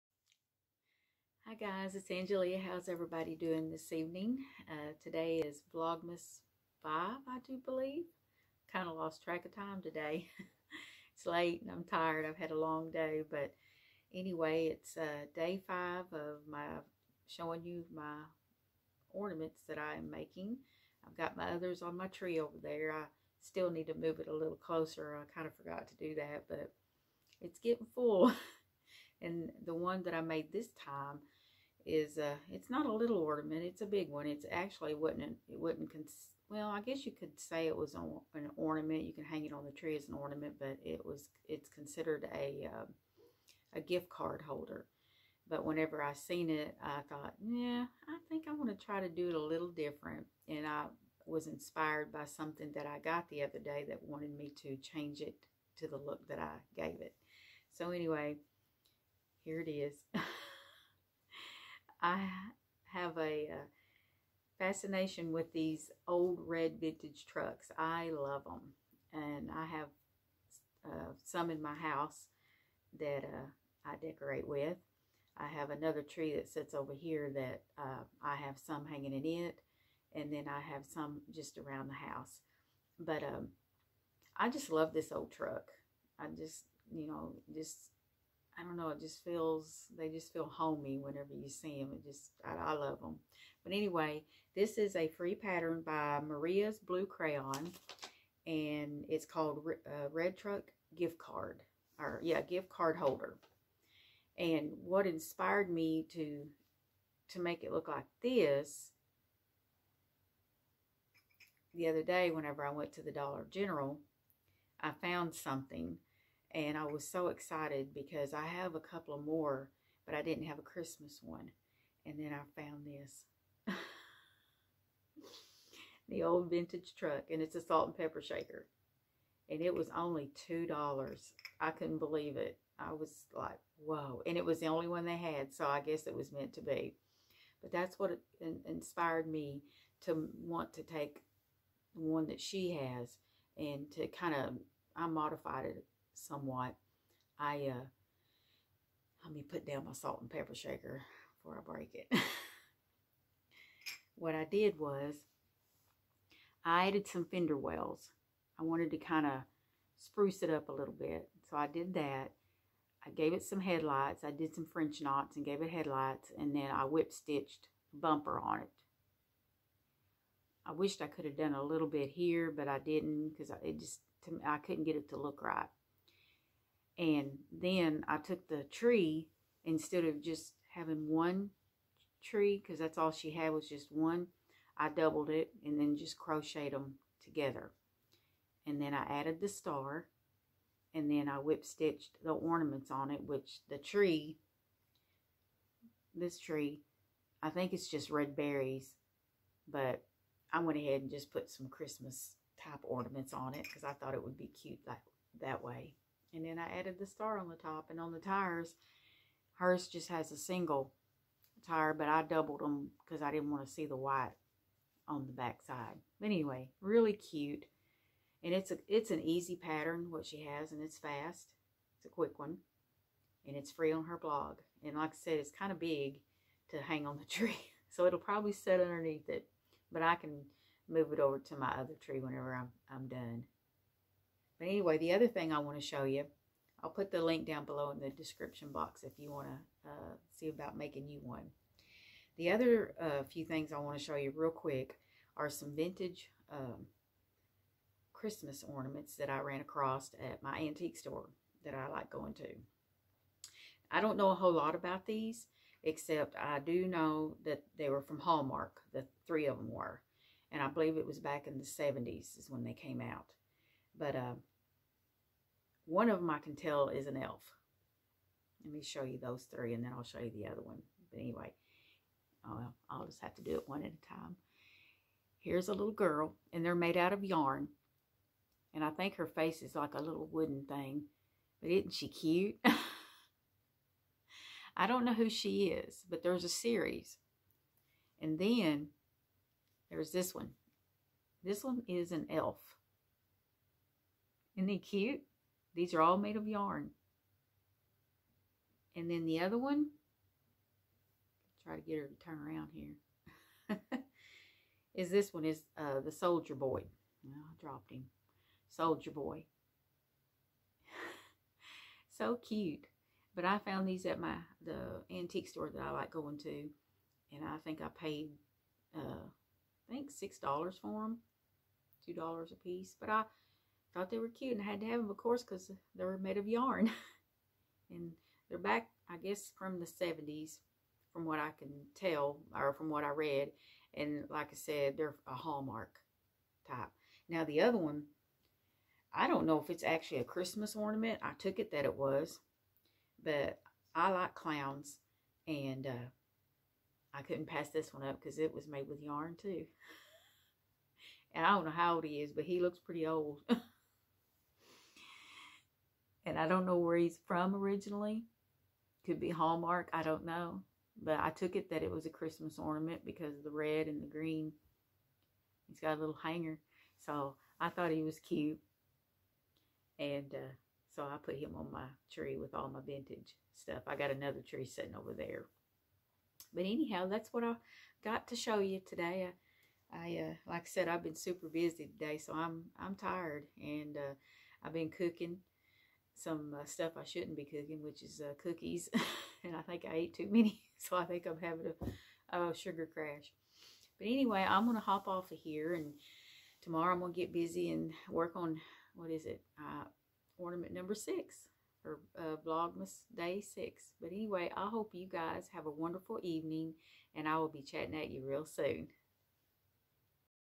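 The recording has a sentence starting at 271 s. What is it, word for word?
But anyway, uh, I'll, just have to do it one at a time.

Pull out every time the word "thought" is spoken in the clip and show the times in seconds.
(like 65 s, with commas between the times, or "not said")
47 s, 203 s, 323 s, 367 s.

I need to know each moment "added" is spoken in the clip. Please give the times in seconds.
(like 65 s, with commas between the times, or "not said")
156 s, 189 s, 206 s.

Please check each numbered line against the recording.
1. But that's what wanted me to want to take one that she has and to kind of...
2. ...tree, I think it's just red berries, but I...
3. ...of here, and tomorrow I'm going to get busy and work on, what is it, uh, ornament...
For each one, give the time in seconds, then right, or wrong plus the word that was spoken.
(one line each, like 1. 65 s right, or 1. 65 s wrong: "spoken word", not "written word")
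1. 137 s wrong: "inspired", not "wanted"
2. 196 s right
3. 395 s right.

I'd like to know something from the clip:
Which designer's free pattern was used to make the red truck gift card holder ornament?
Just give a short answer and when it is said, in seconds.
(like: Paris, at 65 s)
Maria's Blue Crayon, at 96 s.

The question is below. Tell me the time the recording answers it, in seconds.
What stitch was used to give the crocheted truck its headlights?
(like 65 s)
164 s.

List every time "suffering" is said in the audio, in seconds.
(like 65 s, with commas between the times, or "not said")
not said.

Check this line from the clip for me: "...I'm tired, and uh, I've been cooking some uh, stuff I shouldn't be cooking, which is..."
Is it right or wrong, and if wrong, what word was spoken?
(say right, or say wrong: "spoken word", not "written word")
right.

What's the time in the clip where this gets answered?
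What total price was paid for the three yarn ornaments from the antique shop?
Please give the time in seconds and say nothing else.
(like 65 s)
320 s.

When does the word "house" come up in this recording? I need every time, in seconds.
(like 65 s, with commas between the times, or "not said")
71 s, 82 s.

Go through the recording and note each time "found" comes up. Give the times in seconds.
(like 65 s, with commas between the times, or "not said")
114 s, 122 s, 313 s.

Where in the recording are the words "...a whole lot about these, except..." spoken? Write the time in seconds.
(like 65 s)
254 s.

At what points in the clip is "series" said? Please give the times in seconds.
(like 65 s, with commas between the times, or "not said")
286 s.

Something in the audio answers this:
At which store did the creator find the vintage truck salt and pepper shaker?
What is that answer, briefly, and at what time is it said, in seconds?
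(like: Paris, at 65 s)
Dollar General, at 113 s.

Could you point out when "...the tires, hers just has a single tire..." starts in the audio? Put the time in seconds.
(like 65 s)
208 s.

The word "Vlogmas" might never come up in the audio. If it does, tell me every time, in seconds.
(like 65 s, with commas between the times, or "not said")
5 s, 402 s.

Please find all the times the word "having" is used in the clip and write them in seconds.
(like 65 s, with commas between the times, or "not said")
180 s, 391 s.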